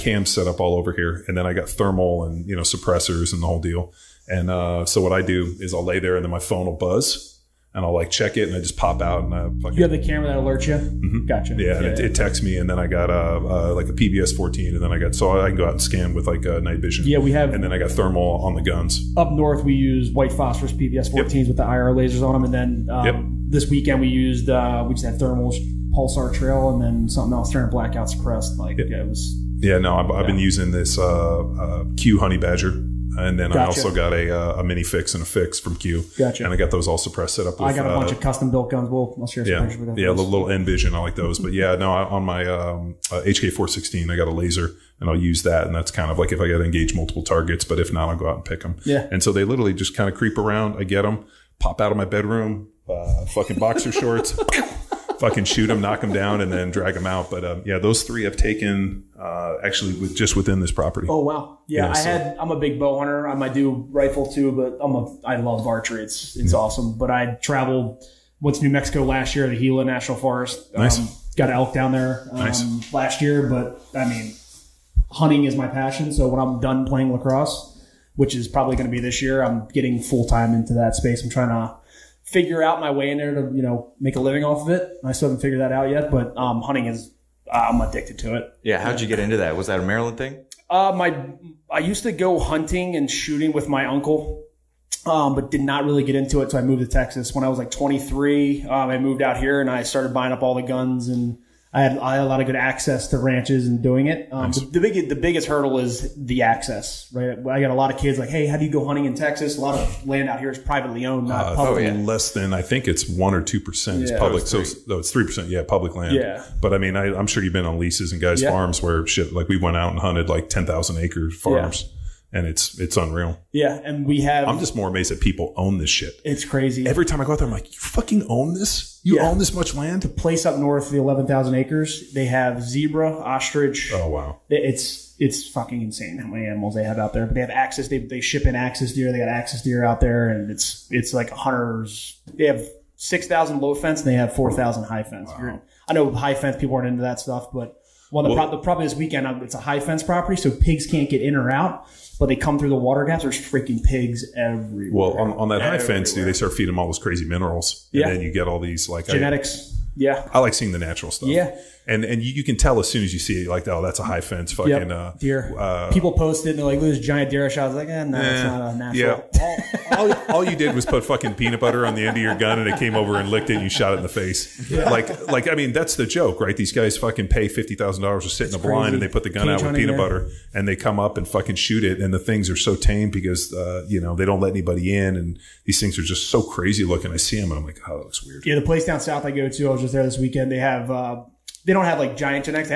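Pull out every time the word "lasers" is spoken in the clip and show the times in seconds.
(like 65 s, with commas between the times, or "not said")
21 s, 44 s.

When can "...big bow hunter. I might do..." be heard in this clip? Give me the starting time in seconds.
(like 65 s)
62 s.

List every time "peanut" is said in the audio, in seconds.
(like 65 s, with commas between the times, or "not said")
171 s, 179 s.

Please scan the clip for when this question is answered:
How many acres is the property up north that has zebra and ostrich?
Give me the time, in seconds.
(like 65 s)
130 s.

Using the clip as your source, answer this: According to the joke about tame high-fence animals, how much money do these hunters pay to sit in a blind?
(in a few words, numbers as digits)
$50,000.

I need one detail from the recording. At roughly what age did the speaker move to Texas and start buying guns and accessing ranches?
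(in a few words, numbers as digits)
23.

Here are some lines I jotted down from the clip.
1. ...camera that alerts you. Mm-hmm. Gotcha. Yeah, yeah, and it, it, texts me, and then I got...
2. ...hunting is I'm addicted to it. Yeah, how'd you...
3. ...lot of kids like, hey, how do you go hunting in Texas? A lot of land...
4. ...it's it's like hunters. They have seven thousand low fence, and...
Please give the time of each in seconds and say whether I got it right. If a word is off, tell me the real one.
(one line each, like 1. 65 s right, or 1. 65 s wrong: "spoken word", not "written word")
1. 9 s right
2. 86 s right
3. 107 s right
4. 140 s wrong: "six", not "seven".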